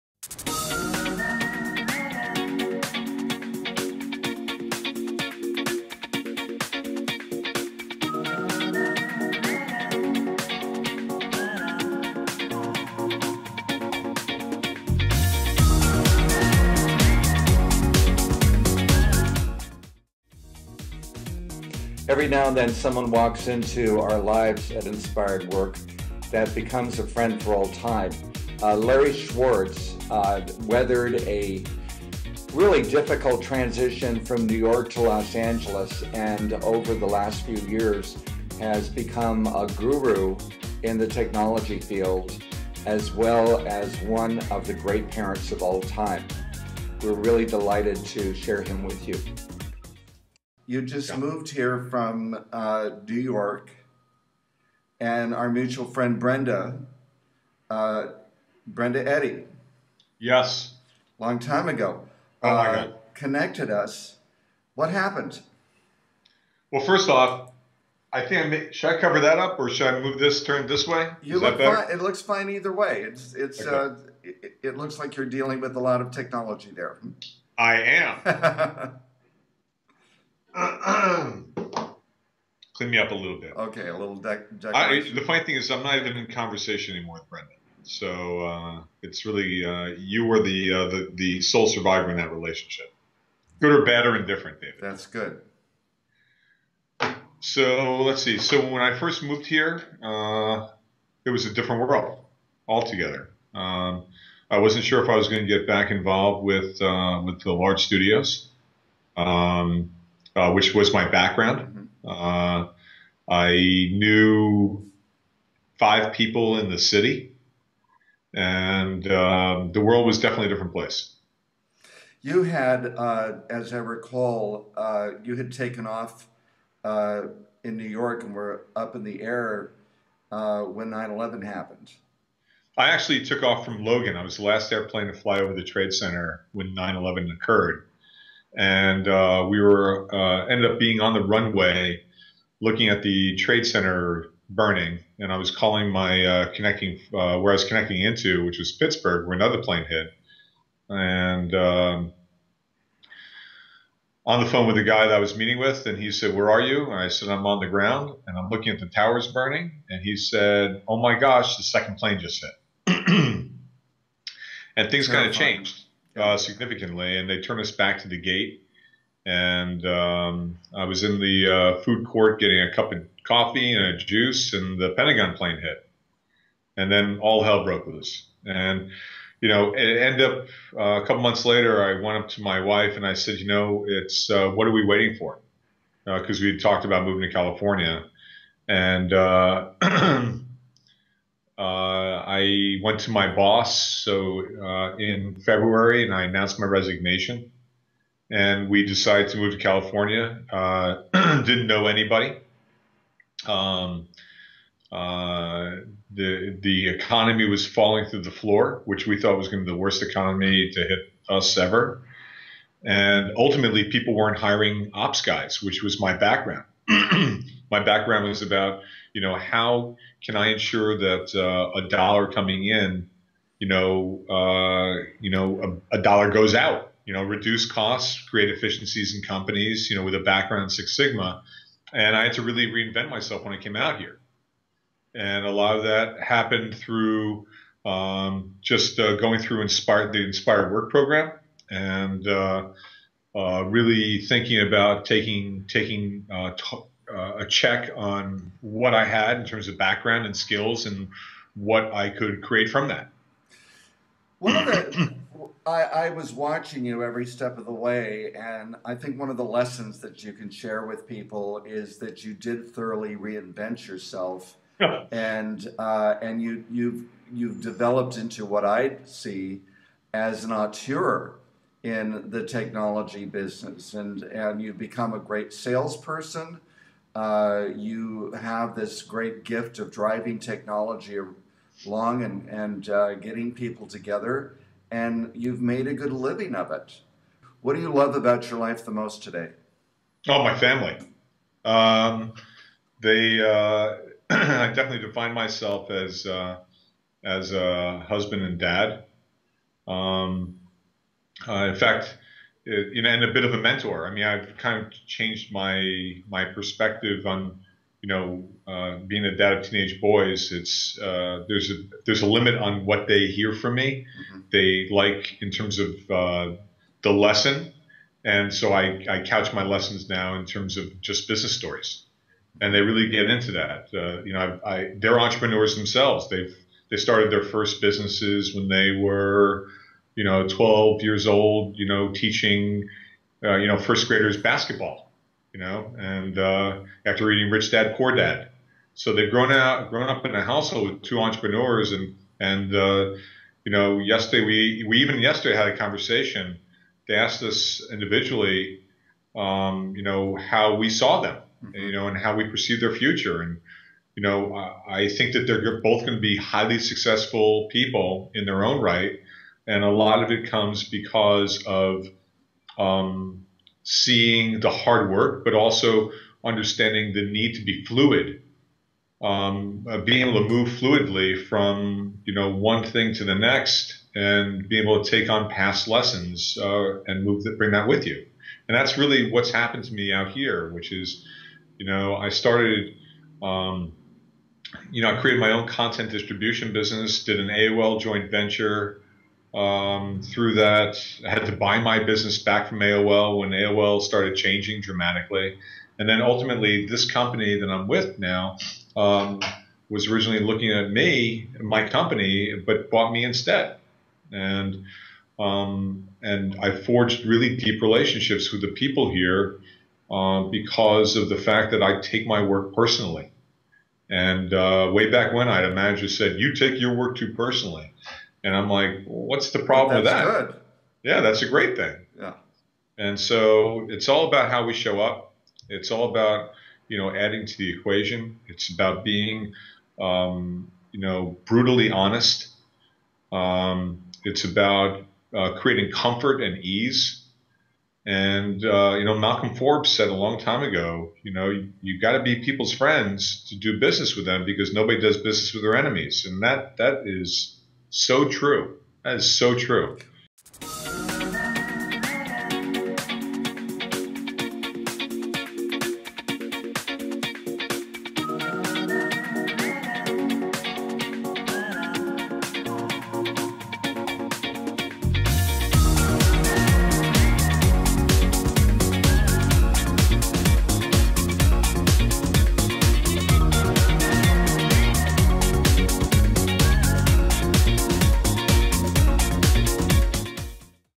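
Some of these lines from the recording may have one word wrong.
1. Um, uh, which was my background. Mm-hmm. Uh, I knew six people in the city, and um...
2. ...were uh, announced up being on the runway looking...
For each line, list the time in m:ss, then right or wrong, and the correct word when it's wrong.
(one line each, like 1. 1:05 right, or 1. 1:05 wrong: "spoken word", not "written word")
1. 1:49 wrong: "five", not "six"
2. 2:19 wrong: "ended", not "announced".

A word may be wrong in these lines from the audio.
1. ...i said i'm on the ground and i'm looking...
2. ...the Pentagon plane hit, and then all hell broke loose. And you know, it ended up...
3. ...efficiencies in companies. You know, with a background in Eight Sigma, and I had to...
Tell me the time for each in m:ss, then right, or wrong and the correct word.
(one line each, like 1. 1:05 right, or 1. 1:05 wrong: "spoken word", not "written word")
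1. 2:36 right
2. 2:54 right
3. 3:48 wrong: "Six", not "Eight".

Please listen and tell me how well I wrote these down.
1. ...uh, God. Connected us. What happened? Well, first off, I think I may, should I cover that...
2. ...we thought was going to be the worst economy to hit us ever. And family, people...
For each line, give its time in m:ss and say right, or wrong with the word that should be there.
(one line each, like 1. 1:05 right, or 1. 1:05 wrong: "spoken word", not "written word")
1. 1:02 right
2. 3:29 wrong: "ultimately", not "family".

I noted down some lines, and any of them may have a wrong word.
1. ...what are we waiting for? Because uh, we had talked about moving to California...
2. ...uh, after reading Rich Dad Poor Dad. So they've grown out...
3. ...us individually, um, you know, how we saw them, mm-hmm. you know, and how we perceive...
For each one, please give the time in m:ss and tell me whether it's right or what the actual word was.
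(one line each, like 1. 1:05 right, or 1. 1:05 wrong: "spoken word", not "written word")
1. 3:04 right
2. 5:36 right
3. 5:47 right.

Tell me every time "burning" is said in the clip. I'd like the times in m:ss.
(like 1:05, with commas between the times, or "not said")
2:24, 2:39.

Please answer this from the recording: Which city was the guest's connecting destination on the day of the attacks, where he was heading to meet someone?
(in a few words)
Pittsburgh.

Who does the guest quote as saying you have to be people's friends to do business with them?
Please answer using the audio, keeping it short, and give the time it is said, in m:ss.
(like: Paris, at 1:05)
Malcolm Forbes, at 7:19.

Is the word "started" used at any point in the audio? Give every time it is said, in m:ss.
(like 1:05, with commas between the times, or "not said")
5:26, 6:22, 6:34.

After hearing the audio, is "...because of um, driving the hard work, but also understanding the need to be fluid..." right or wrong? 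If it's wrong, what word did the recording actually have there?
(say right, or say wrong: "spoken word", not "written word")
wrong: "seeing", not "driving".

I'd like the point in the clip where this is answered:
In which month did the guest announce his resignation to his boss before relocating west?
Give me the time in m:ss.
3:15.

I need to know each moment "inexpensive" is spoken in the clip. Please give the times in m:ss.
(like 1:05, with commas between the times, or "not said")
not said.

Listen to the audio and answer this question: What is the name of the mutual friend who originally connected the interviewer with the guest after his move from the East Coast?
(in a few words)
Brenda Eddy.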